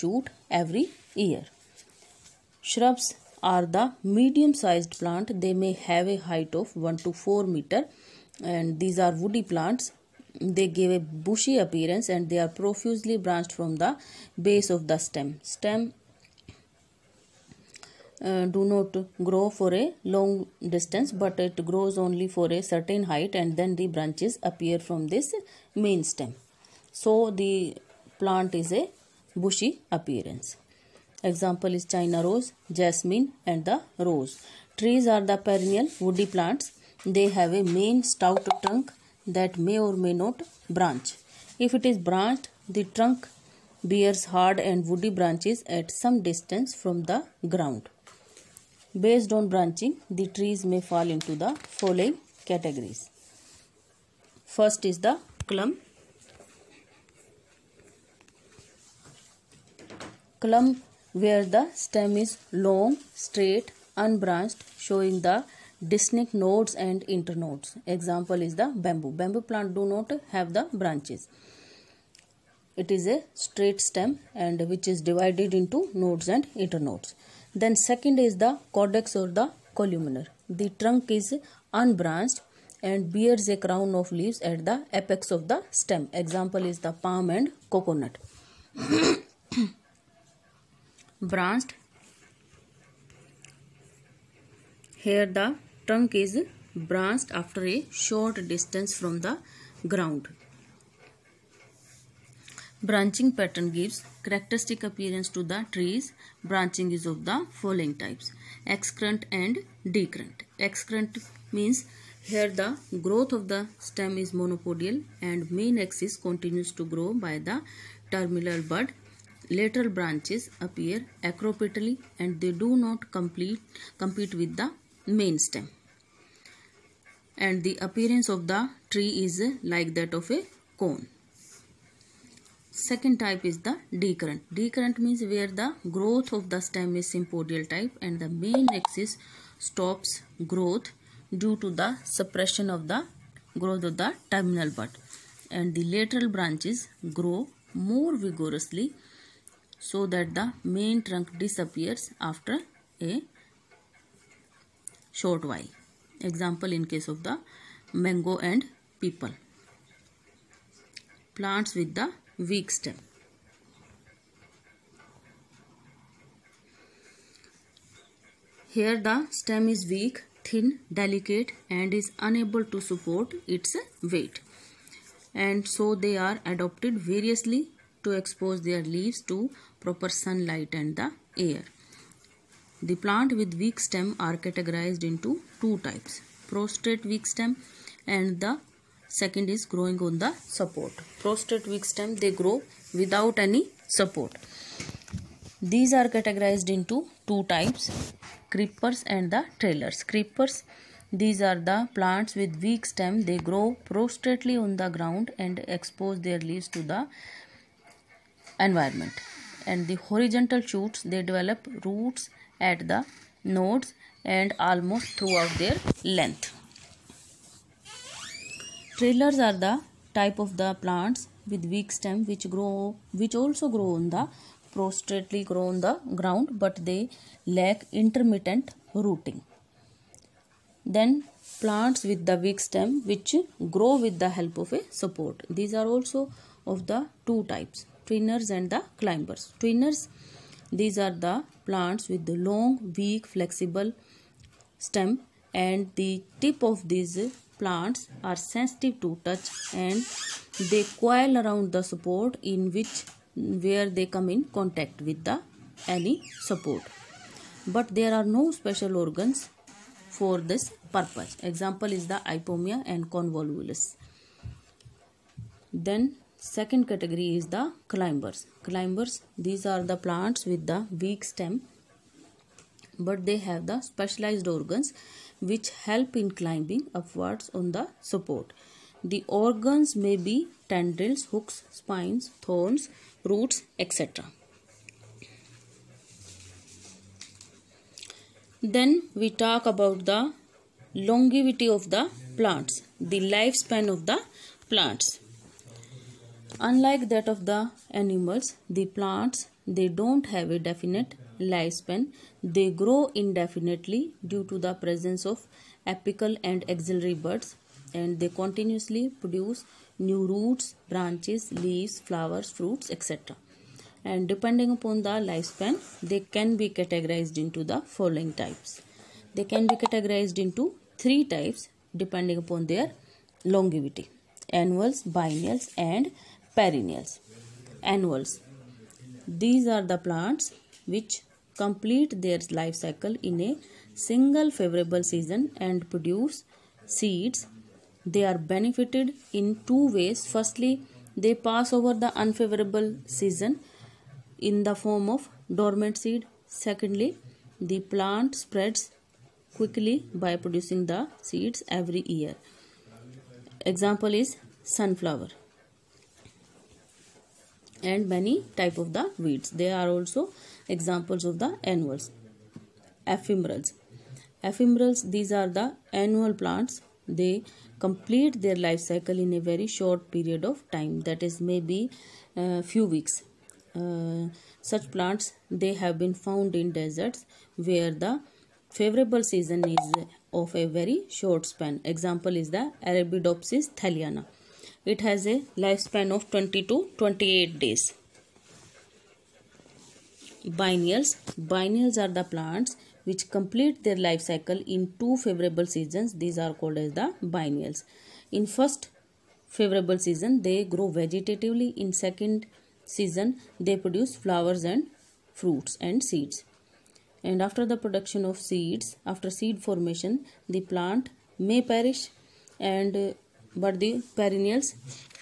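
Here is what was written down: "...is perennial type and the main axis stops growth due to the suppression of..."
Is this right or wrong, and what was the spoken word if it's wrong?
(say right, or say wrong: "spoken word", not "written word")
wrong: "sympodial", not "perennial".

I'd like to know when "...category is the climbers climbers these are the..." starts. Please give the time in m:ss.
4:26.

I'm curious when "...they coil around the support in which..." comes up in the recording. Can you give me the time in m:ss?
4:10.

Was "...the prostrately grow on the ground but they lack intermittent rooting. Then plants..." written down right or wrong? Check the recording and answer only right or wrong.
right.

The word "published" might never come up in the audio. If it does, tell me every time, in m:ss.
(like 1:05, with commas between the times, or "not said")
not said.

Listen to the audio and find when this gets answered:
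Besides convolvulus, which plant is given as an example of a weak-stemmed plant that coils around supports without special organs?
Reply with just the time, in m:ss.
4:22.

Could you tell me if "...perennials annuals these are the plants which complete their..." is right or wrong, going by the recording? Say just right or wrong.
right.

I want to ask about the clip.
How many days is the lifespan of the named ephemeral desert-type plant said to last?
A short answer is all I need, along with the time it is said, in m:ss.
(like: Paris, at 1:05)
20 to 28 days, at 6:26.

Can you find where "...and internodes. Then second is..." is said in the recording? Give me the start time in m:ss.
1:16.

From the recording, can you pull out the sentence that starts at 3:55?
These are also of the two types trainers and the climbers.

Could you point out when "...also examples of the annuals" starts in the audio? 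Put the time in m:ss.
5:59.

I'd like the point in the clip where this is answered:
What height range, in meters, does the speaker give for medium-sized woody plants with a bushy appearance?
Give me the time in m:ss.
0:06.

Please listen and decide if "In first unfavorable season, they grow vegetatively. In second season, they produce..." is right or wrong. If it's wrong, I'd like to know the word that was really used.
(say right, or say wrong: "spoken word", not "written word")
wrong: "favorable", not "unfavorable".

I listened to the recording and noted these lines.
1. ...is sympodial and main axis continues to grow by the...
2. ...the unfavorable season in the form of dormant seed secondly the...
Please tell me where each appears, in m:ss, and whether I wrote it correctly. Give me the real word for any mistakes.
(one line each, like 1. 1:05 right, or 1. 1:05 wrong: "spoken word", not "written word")
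1. 1:54 wrong: "monopodial", not "sympodial"
2. 5:42 right.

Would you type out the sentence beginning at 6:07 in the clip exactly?
They complete their life cycle in a very short period of time.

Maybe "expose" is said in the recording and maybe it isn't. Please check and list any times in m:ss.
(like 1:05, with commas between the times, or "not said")
2:58, 3:25.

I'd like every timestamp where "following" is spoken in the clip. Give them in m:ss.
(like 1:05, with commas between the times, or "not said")
0:51, 1:47, 5:17.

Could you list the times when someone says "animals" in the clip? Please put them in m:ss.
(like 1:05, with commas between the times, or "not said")
4:57.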